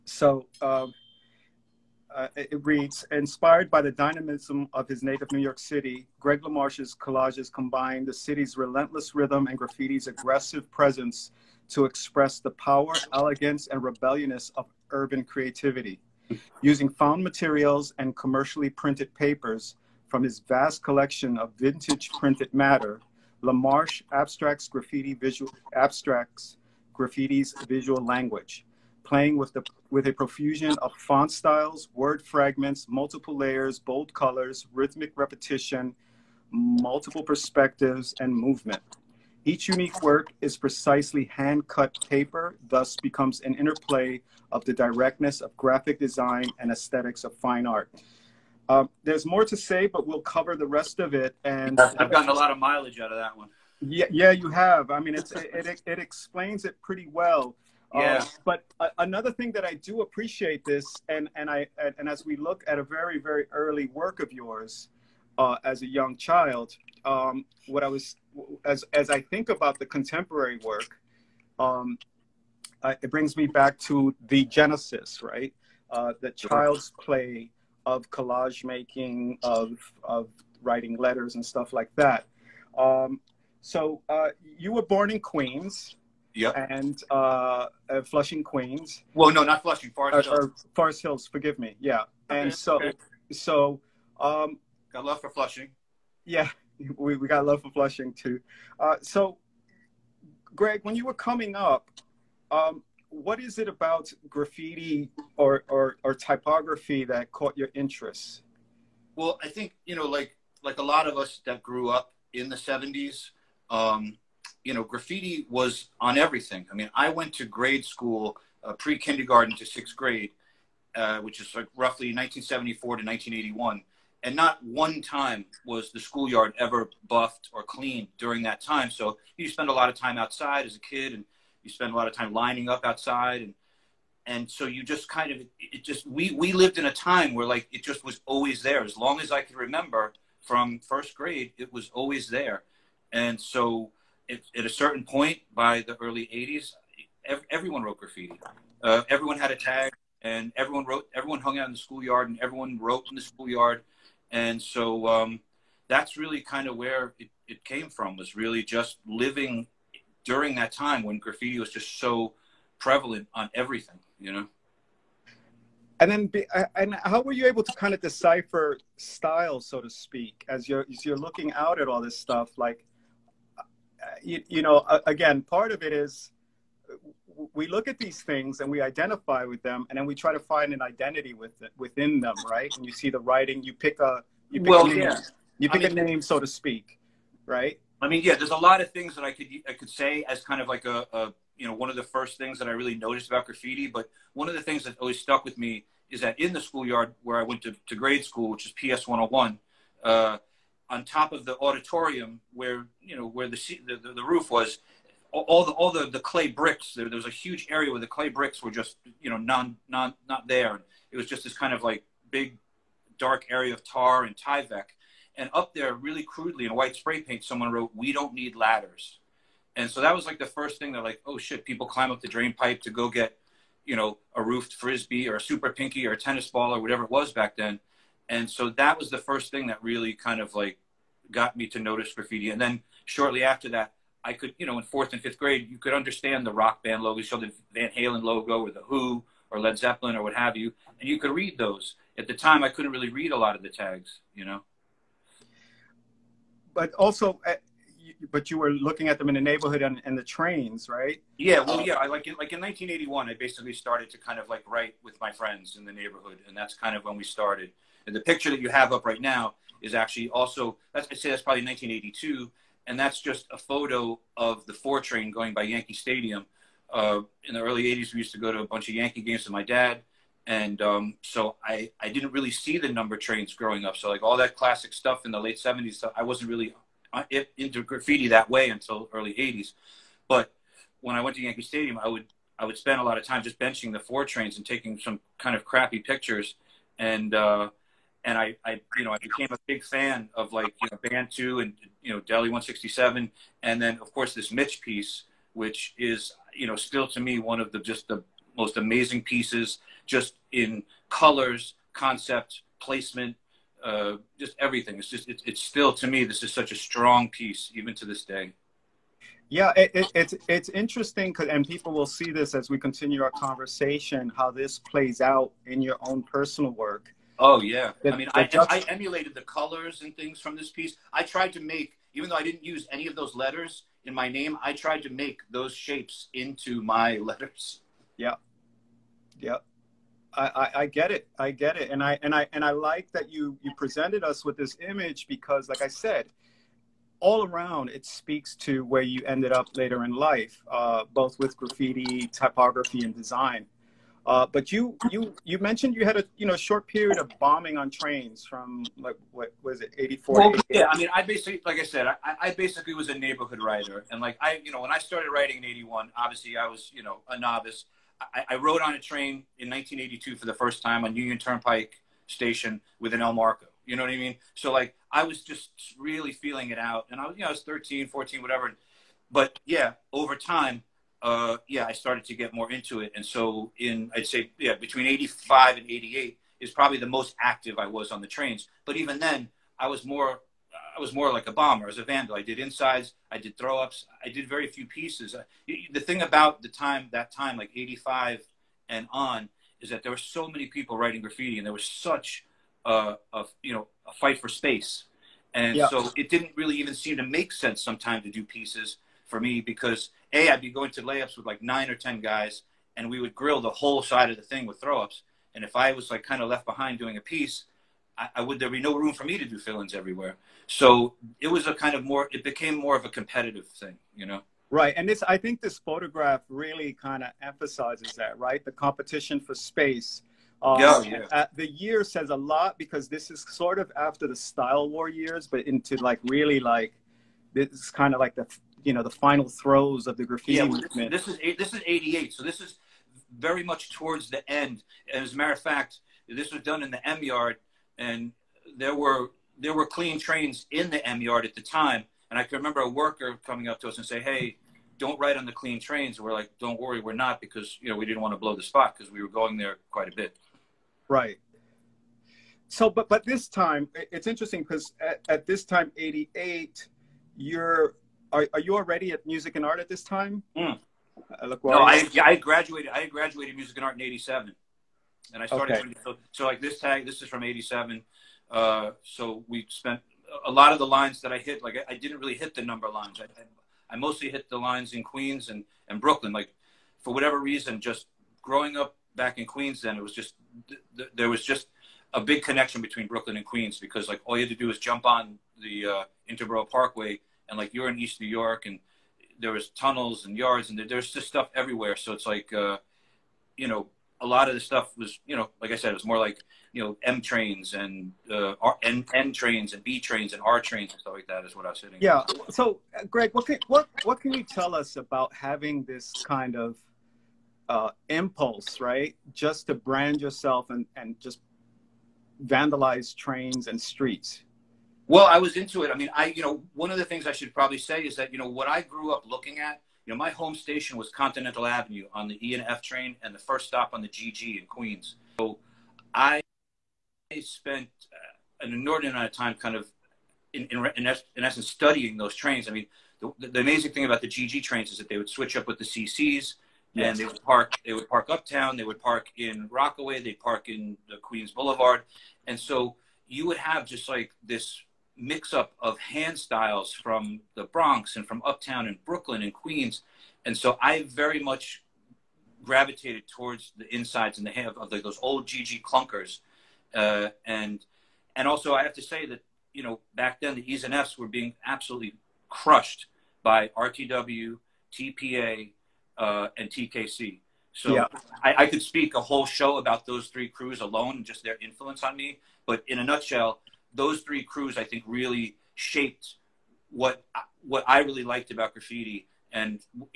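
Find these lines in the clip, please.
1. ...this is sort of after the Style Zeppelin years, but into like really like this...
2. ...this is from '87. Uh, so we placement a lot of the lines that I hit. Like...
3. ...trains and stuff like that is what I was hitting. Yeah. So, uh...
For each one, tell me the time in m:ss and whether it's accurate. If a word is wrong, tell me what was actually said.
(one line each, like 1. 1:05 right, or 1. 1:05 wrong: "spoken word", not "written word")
1. 7:03 wrong: "War", not "Zeppelin"
2. 7:47 wrong: "spent", not "placement"
3. 8:20 right.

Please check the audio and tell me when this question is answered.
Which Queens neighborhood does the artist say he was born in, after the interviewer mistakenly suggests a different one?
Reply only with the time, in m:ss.
1:29.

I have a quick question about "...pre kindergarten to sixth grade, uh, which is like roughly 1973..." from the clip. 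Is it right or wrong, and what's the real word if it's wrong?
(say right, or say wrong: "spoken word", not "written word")
wrong: "1974", not "1973".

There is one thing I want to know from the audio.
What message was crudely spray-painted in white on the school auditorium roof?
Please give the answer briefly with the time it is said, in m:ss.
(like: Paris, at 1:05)
we don't need ladders, at 3:37.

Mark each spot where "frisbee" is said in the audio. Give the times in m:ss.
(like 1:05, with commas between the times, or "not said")
3:44.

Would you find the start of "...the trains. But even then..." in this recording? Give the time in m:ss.
6:18.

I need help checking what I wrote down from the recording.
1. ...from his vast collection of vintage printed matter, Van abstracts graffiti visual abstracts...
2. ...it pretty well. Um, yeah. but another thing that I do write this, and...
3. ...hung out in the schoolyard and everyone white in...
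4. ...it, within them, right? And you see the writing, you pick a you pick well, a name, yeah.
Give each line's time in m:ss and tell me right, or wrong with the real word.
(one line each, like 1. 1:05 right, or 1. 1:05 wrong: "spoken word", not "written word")
1. 0:20 wrong: "LaMarche", not "Van"
2. 0:56 wrong: "appreciate", not "write"
3. 2:31 wrong: "wrote", not "white"
4. 3:01 right.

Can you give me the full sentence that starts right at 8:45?
So I spent uh, an inordinate amount of time kind of in, in, in essence studying those trains.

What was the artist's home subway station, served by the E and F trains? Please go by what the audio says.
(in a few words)
Continental Avenue.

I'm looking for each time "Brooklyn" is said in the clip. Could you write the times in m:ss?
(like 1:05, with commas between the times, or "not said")
7:56, 8:03, 9:09.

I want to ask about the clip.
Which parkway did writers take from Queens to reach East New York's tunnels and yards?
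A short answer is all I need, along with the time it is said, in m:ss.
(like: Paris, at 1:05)
Interborough Parkway, at 8:06.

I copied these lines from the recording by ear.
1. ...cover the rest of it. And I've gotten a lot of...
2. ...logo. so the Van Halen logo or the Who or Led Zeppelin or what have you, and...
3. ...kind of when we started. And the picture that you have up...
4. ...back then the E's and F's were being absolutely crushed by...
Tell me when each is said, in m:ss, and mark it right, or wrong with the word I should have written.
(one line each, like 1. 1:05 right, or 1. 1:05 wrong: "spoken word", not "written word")
1. 0:50 right
2. 3:57 right
3. 4:16 right
4. 9:20 right.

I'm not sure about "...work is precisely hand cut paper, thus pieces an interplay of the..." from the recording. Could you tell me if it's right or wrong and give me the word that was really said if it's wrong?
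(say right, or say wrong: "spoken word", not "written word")
wrong: "becomes", not "pieces".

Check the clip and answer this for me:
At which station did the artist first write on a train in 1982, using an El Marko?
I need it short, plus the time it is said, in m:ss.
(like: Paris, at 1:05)
Union Turnpike, at 6:01.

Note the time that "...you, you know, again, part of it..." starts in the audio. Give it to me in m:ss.
2:54.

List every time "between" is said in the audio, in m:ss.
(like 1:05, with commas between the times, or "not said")
6:14, 8:02.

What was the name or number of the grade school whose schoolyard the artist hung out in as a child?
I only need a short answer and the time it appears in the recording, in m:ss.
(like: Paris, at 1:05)
PS 101, at 3:18.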